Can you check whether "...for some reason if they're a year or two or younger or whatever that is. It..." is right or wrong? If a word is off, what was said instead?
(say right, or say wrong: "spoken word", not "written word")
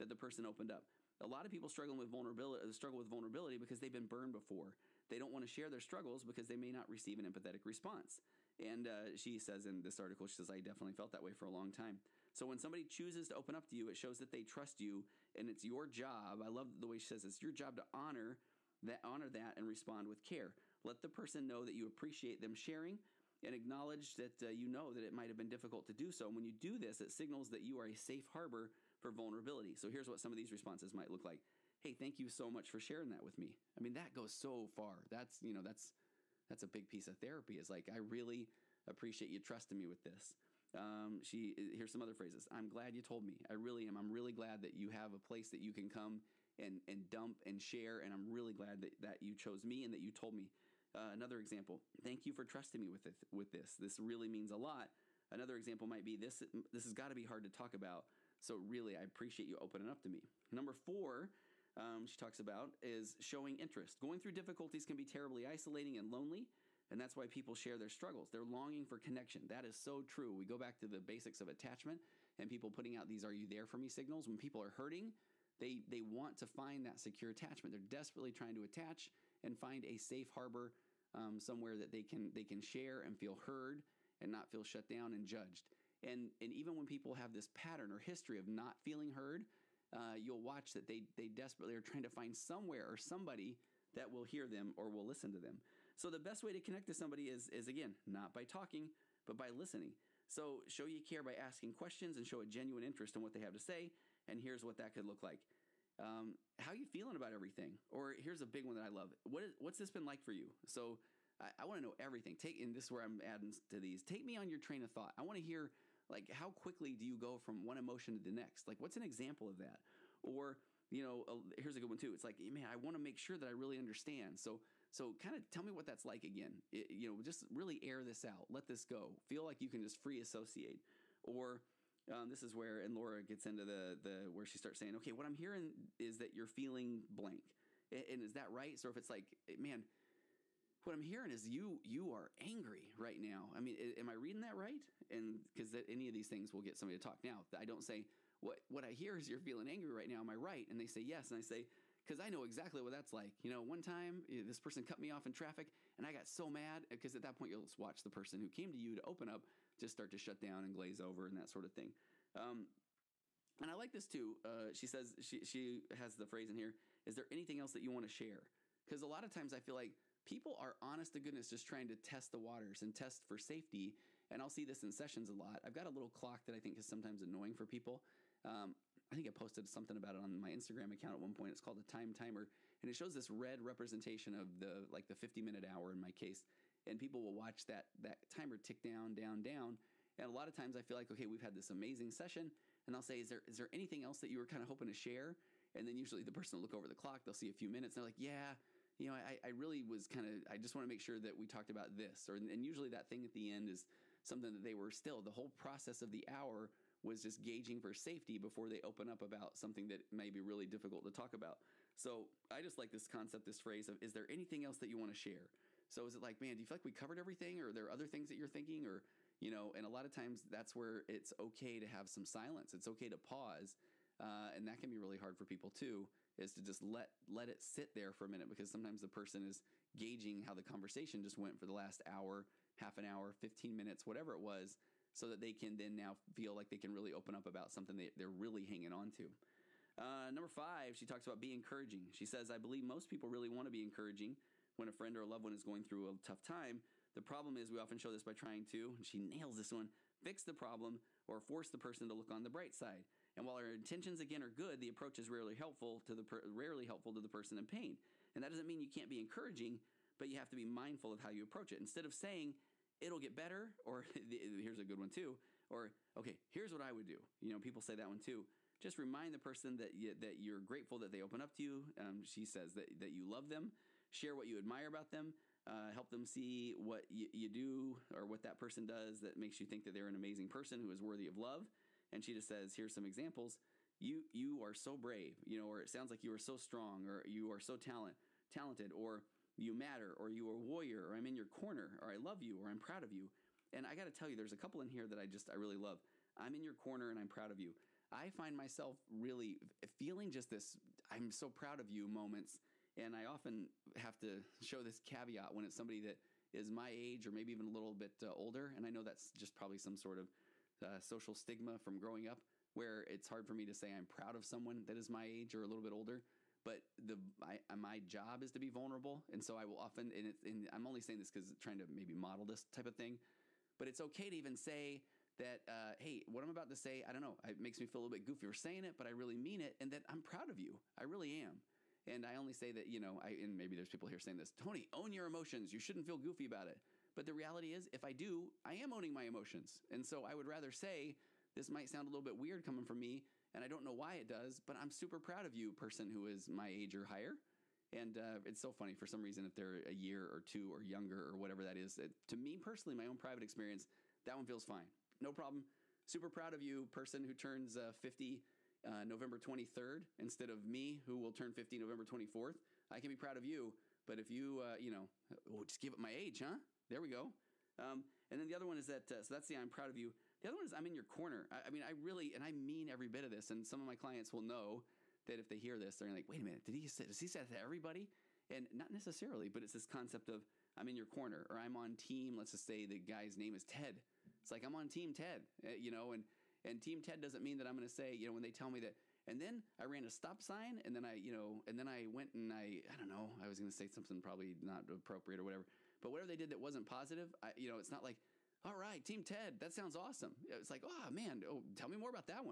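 right.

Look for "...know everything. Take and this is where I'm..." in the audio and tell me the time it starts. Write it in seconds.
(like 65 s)
111 s.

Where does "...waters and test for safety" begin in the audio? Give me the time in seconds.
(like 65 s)
172 s.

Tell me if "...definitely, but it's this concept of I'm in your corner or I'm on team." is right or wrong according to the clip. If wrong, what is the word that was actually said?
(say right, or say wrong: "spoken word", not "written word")
wrong: "necessarily", not "definitely".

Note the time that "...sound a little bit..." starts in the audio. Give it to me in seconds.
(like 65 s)
341 s.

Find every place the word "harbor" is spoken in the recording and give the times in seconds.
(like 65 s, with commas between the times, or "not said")
28 s, 80 s.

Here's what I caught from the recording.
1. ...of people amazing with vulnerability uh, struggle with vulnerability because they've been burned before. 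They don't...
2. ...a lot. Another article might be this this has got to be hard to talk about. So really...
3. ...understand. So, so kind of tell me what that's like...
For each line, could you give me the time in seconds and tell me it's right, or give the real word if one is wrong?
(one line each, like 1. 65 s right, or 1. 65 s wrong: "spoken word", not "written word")
1. 1 s wrong: "struggling", not "amazing"
2. 54 s wrong: "example", not "article"
3. 123 s right.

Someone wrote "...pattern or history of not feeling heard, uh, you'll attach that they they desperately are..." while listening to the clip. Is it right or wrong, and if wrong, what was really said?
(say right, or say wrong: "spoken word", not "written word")
wrong: "watch", not "attach".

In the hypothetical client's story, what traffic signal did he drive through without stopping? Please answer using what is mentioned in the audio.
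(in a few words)
stop sign.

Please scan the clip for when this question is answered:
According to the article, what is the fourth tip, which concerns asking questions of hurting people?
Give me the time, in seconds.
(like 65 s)
63 s.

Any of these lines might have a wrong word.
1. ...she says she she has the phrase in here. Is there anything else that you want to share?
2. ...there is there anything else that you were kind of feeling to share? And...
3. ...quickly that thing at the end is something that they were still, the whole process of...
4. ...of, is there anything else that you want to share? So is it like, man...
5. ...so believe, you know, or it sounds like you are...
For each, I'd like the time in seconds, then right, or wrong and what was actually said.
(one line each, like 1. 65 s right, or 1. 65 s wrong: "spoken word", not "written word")
1. 164 s right
2. 193 s wrong: "hoping", not "feeling"
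3. 202 s wrong: "usually", not "quickly"
4. 213 s right
5. 284 s wrong: "brave", not "believe".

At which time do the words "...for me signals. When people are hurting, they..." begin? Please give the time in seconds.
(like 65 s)
73 s.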